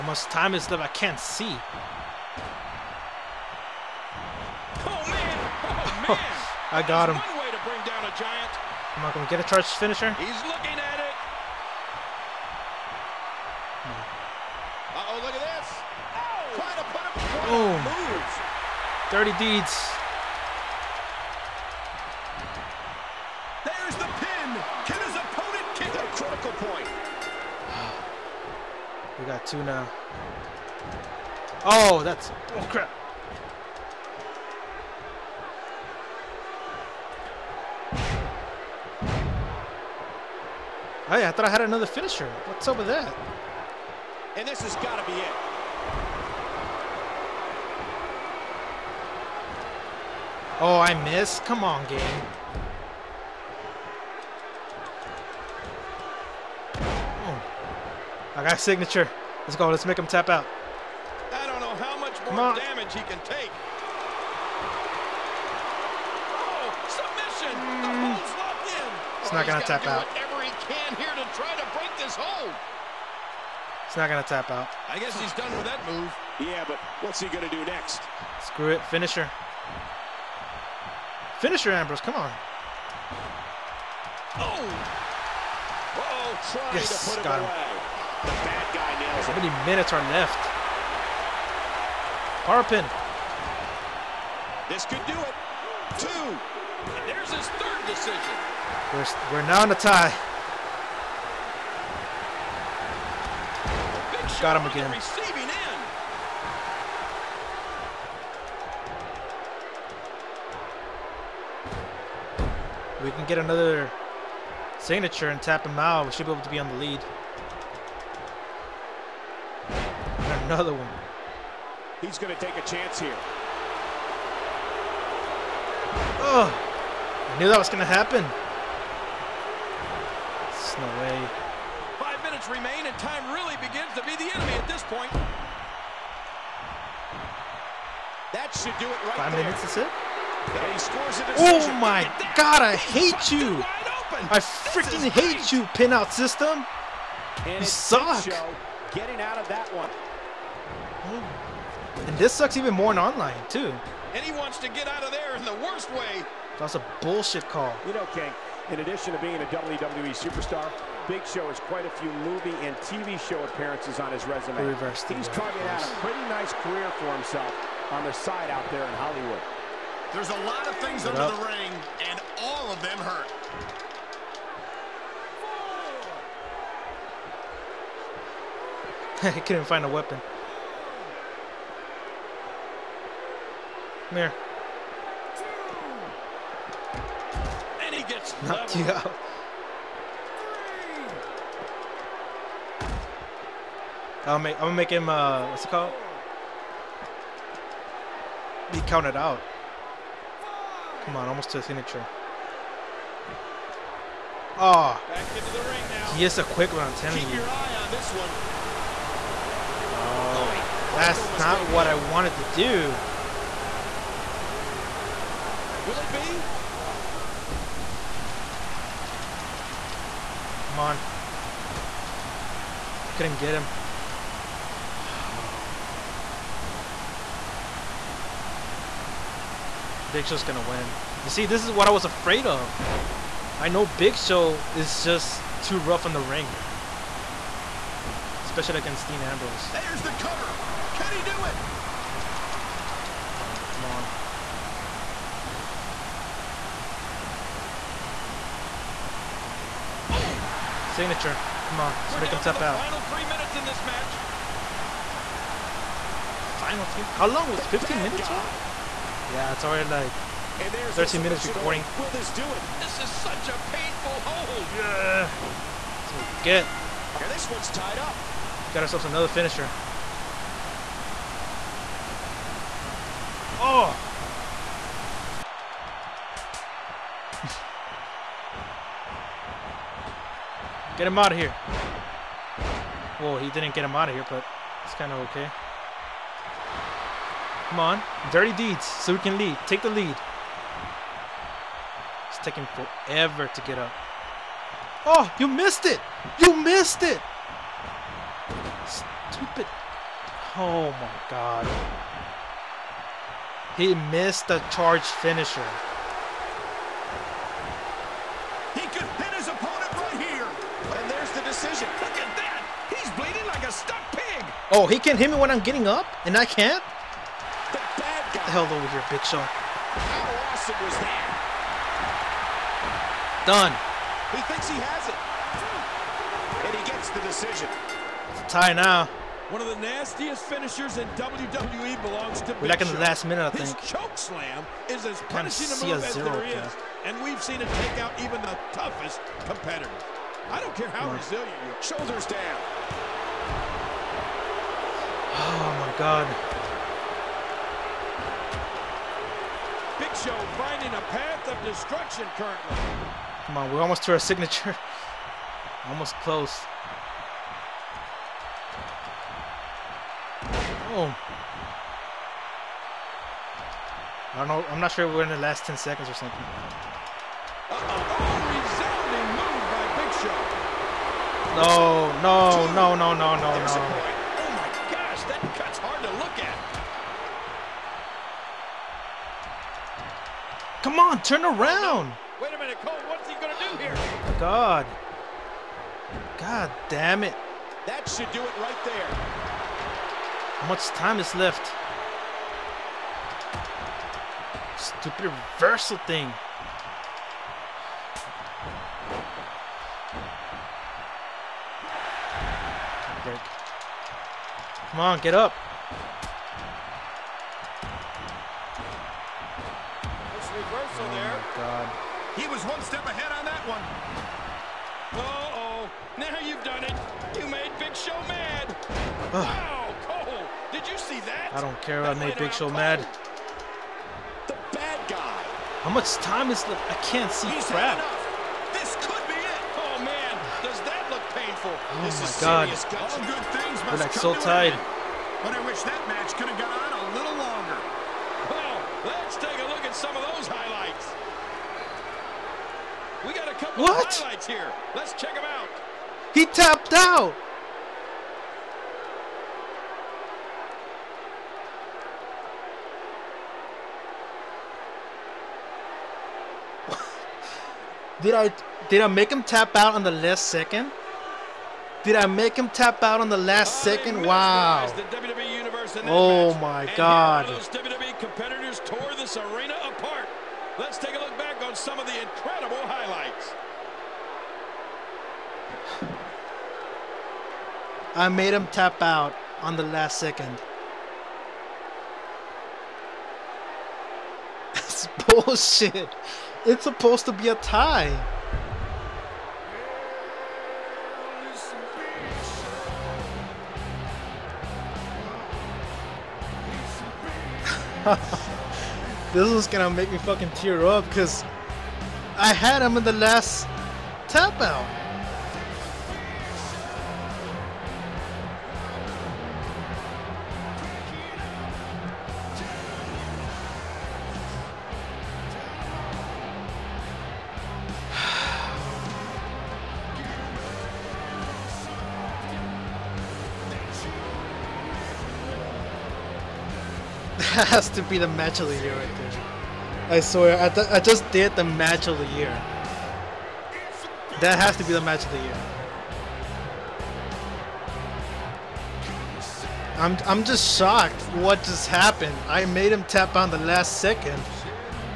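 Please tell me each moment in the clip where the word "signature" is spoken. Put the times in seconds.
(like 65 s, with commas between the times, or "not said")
58 s, 114 s, 201 s, 250 s, 354 s.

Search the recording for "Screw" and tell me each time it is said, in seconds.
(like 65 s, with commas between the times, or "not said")
78 s.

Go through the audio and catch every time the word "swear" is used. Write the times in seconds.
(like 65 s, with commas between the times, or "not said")
530 s.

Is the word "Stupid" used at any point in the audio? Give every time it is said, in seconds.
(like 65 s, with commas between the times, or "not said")
298 s, 394 s.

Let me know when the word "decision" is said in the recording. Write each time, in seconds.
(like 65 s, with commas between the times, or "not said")
97 s, 327 s.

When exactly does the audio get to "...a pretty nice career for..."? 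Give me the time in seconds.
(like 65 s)
165 s.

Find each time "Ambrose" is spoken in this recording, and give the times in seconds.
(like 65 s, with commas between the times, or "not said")
81 s, 239 s.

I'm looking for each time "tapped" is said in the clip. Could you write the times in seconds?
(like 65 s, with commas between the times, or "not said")
446 s.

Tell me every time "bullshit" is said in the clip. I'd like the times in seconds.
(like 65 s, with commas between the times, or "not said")
157 s, 485 s.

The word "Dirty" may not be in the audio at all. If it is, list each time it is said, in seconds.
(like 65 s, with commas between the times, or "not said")
19 s, 288 s.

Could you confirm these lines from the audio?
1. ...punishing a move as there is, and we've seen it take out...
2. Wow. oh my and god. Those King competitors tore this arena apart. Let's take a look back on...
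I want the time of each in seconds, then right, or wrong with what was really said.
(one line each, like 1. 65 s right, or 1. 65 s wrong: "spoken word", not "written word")
1. 335 s right
2. 464 s wrong: "WWE", not "King".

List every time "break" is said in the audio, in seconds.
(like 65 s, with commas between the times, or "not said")
71 s.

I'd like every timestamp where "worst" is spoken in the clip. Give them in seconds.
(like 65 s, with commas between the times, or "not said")
155 s.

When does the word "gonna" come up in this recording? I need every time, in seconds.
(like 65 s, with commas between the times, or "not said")
194 s, 230 s, 383 s, 499 s.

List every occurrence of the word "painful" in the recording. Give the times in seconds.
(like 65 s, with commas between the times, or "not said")
263 s, 431 s.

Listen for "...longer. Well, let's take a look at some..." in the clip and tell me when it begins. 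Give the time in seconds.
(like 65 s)
437 s.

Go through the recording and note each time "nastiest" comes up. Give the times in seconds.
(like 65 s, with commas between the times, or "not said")
329 s.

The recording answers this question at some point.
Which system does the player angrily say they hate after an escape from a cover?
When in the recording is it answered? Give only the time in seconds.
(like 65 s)
145 s.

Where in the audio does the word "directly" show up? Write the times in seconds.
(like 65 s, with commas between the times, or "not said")
not said.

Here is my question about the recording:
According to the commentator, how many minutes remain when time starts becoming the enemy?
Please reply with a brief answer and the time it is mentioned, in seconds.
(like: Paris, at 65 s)
5, at 131 s.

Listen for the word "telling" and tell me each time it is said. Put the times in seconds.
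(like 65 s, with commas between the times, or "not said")
206 s.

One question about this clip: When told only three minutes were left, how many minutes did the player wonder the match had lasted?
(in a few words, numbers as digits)
15.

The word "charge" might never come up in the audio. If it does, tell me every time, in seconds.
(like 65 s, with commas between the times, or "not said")
9 s, 304 s.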